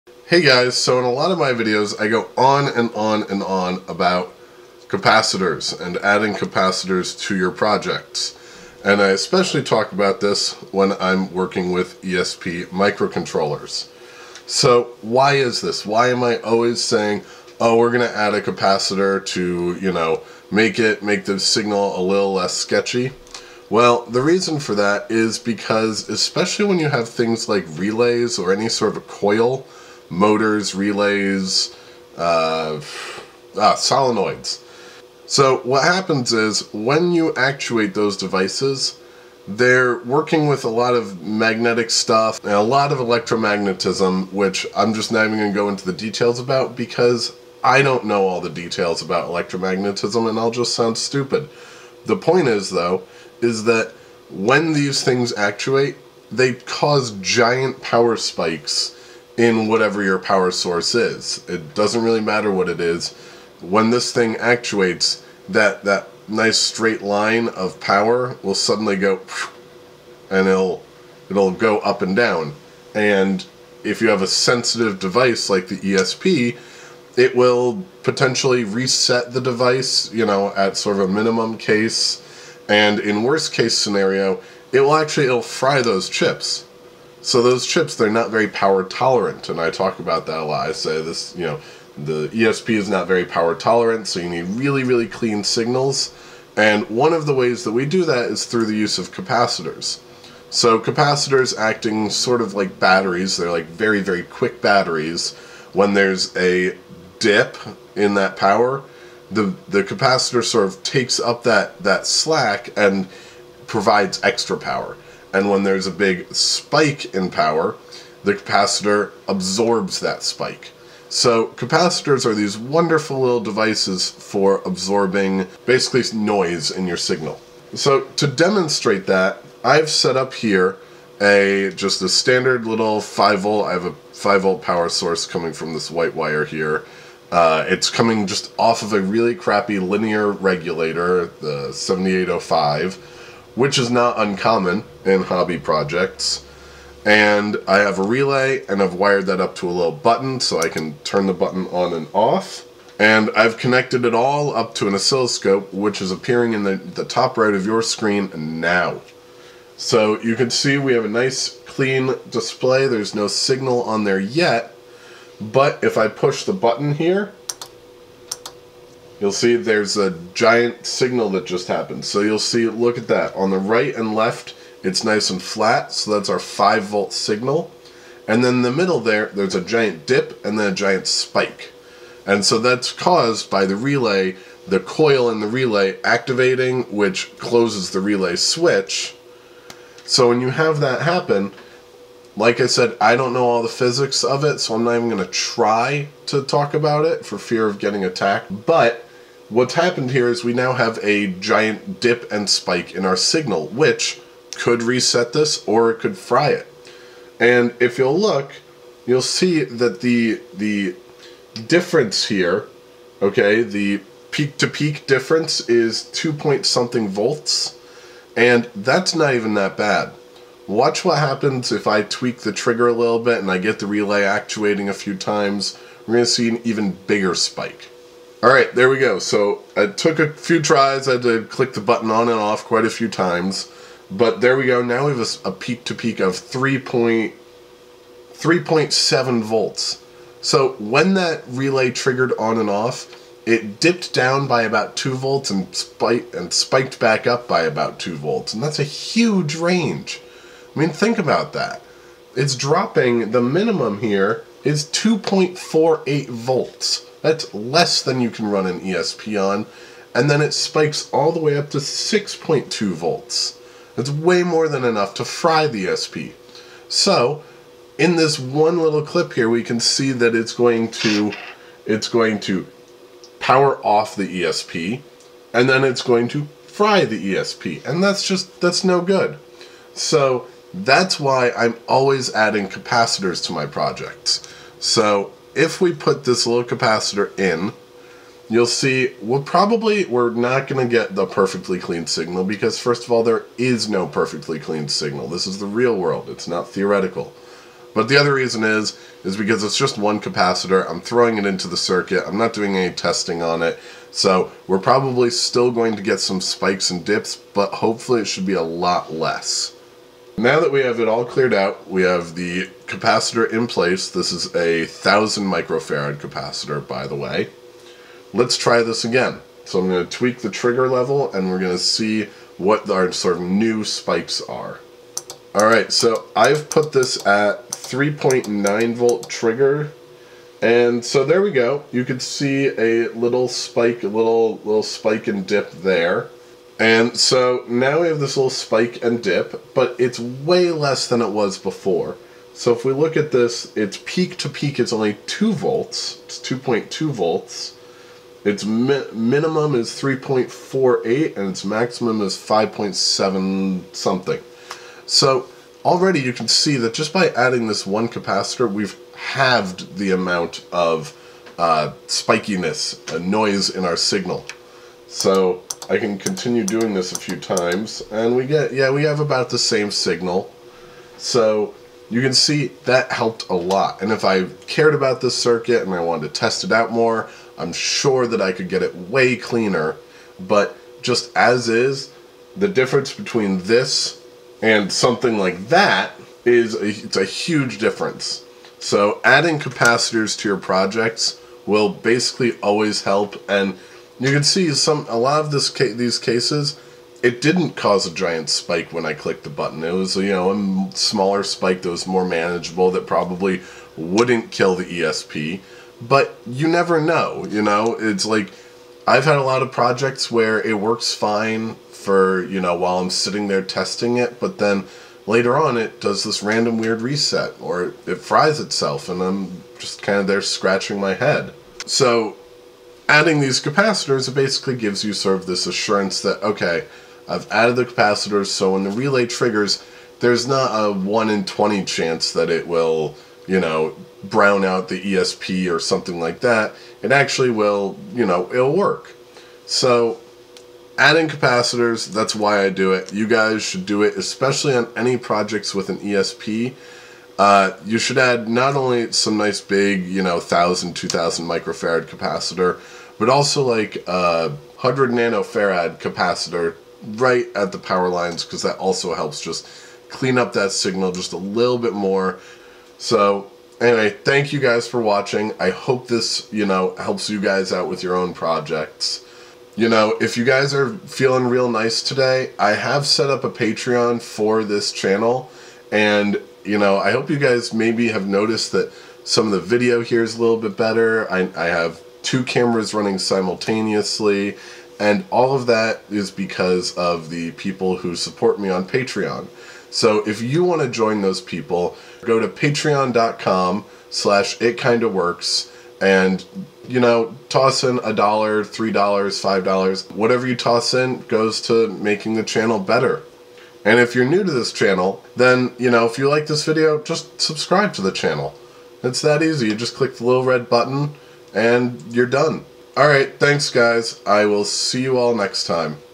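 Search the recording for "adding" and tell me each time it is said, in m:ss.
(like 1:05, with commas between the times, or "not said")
0:05, 4:42, 5:57, 6:29, 7:03, 7:20.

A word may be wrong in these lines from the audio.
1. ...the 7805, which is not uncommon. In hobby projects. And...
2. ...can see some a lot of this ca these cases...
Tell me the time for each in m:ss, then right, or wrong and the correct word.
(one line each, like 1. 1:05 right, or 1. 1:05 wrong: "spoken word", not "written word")
1. 2:21 right
2. 6:34 right.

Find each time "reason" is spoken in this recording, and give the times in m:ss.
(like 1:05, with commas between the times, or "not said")
0:24, 4:58.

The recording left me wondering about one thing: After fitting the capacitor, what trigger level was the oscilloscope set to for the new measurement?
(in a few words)
3.9 volt.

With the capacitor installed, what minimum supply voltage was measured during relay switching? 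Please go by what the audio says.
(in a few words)
3.48.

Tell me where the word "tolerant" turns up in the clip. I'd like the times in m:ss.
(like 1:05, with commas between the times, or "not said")
1:28, 1:33.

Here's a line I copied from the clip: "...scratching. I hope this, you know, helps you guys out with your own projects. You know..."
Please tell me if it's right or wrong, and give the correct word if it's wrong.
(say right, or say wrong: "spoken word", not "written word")
wrong: "watching", not "scratching".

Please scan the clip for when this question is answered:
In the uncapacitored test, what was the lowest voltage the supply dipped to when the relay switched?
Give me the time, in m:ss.
4:14.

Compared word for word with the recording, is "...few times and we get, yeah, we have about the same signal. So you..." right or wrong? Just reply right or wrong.
right.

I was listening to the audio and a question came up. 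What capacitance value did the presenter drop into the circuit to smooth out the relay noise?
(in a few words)
1000 microfarad.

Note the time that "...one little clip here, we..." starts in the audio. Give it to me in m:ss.
4:28.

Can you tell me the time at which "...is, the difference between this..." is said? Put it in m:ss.
6:21.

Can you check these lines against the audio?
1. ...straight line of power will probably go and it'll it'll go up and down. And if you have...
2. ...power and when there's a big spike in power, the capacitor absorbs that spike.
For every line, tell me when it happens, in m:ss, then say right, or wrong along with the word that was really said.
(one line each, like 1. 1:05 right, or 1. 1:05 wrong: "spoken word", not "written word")
1. 1:06 wrong: "suddenly", not "probably"
2. 1:54 right.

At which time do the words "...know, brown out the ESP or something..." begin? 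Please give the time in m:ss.
7:13.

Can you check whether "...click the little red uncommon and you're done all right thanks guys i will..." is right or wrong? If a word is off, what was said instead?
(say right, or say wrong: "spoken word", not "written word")
wrong: "button", not "uncommon".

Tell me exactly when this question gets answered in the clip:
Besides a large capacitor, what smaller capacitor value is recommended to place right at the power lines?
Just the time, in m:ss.
7:34.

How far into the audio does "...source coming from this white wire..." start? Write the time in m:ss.
2:14.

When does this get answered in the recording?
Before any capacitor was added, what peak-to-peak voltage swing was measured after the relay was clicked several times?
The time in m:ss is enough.
3:56.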